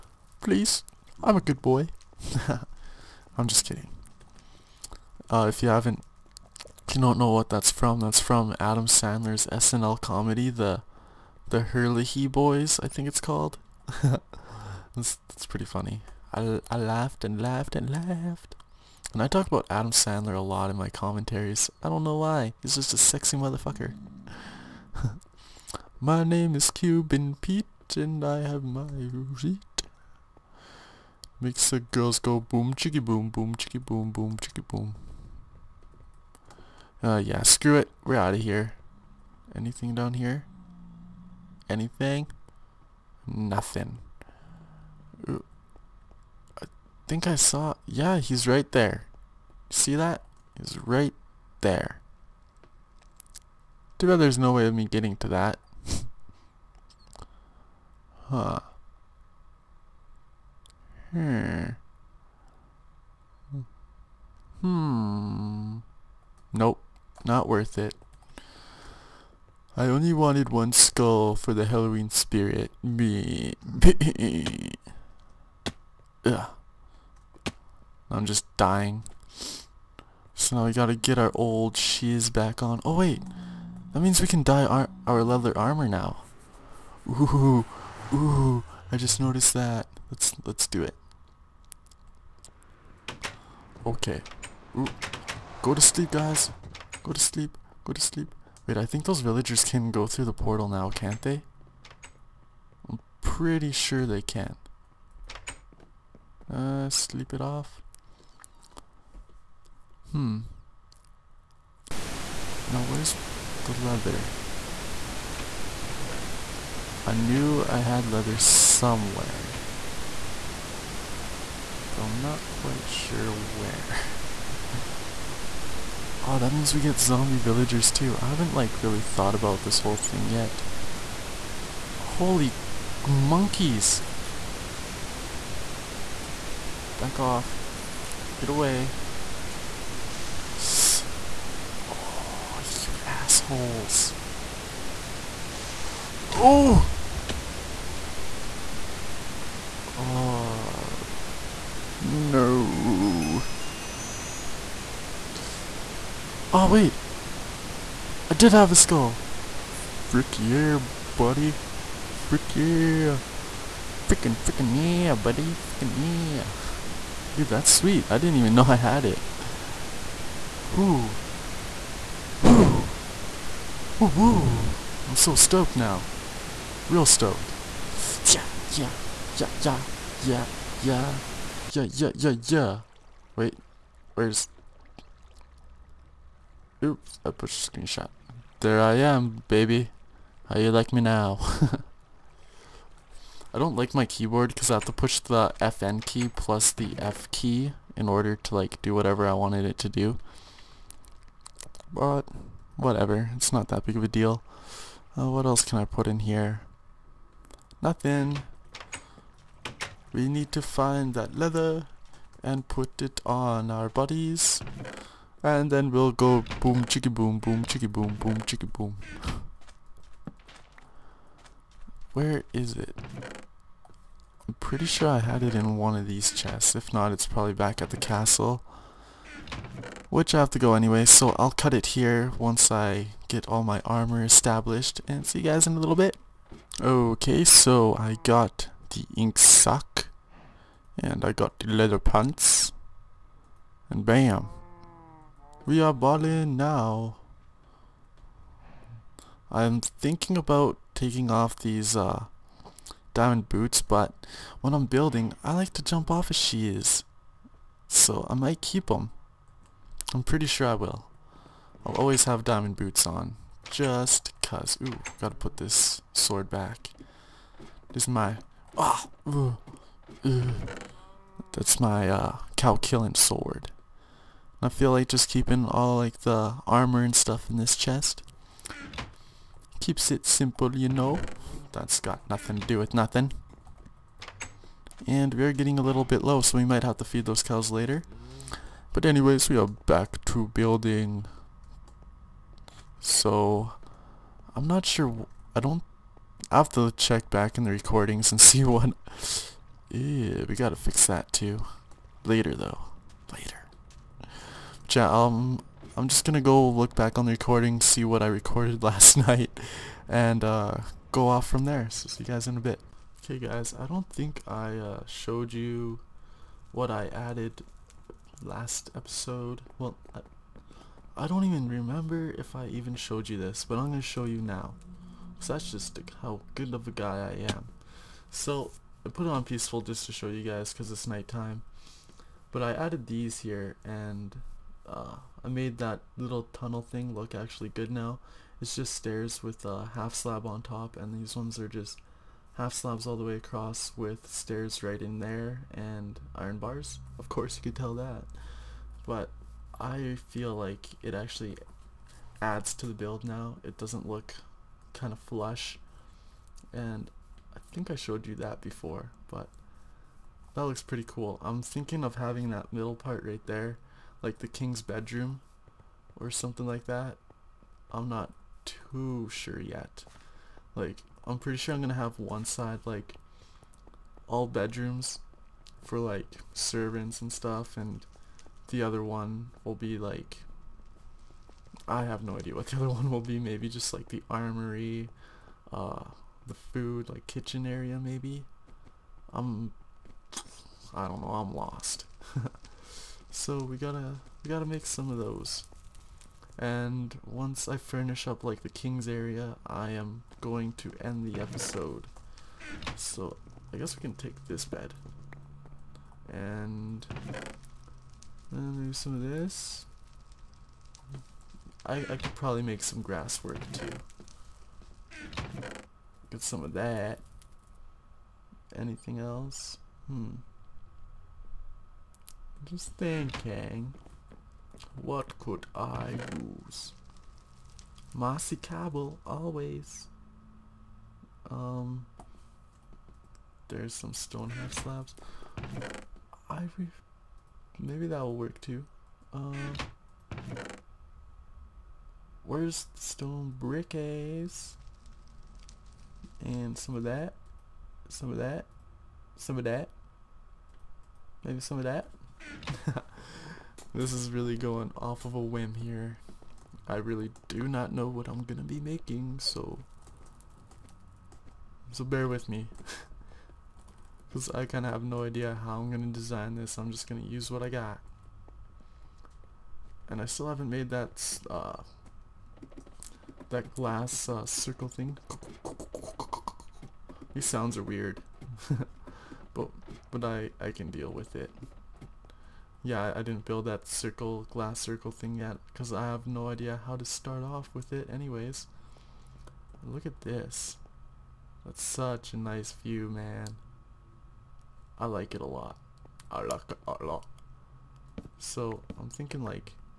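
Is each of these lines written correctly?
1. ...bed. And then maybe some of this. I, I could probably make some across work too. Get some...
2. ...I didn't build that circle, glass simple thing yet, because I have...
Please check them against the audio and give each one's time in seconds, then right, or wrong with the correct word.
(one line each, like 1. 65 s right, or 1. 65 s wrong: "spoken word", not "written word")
1. 404 s wrong: "grass", not "across"
2. 483 s wrong: "circle", not "simple".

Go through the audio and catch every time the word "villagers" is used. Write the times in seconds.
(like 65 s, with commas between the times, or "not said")
99 s, 127 s.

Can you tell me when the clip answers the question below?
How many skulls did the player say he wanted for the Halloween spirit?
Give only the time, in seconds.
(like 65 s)
70 s.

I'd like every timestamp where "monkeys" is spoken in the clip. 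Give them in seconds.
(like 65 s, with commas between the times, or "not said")
133 s.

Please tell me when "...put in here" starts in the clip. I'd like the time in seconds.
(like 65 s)
205 s.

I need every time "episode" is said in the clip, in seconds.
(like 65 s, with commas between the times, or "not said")
318 s, 401 s.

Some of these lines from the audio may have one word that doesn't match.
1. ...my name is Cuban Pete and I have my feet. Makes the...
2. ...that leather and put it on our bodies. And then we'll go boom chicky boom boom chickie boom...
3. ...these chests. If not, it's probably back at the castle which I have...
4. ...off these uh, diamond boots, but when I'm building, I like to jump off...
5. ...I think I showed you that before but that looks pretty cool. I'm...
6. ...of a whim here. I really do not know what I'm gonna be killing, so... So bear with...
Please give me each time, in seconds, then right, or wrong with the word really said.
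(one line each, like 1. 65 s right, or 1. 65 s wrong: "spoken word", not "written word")
1. 26 s right
2. 211 s right
3. 226 s right
4. 251 s right
5. 357 s right
6. 455 s wrong: "making", not "killing".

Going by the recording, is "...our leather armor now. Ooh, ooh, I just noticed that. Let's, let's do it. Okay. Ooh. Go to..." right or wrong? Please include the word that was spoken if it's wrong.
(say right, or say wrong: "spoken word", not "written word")
right.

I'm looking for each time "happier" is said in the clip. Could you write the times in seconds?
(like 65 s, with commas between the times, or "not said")
not said.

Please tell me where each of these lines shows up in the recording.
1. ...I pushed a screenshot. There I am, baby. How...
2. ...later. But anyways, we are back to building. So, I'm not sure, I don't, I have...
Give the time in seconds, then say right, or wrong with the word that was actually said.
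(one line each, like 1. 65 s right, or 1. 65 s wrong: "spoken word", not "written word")
1. 187 s right
2. 287 s right.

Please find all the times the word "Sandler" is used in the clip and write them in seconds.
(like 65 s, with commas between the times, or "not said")
8 s, 19 s.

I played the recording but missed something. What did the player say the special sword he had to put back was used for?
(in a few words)
cow killing.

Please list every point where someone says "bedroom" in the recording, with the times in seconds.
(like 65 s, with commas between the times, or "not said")
364 s, 374 s.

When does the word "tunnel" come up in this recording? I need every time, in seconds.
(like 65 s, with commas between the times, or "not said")
336 s.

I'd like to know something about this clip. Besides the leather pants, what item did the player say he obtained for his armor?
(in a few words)
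ink sac.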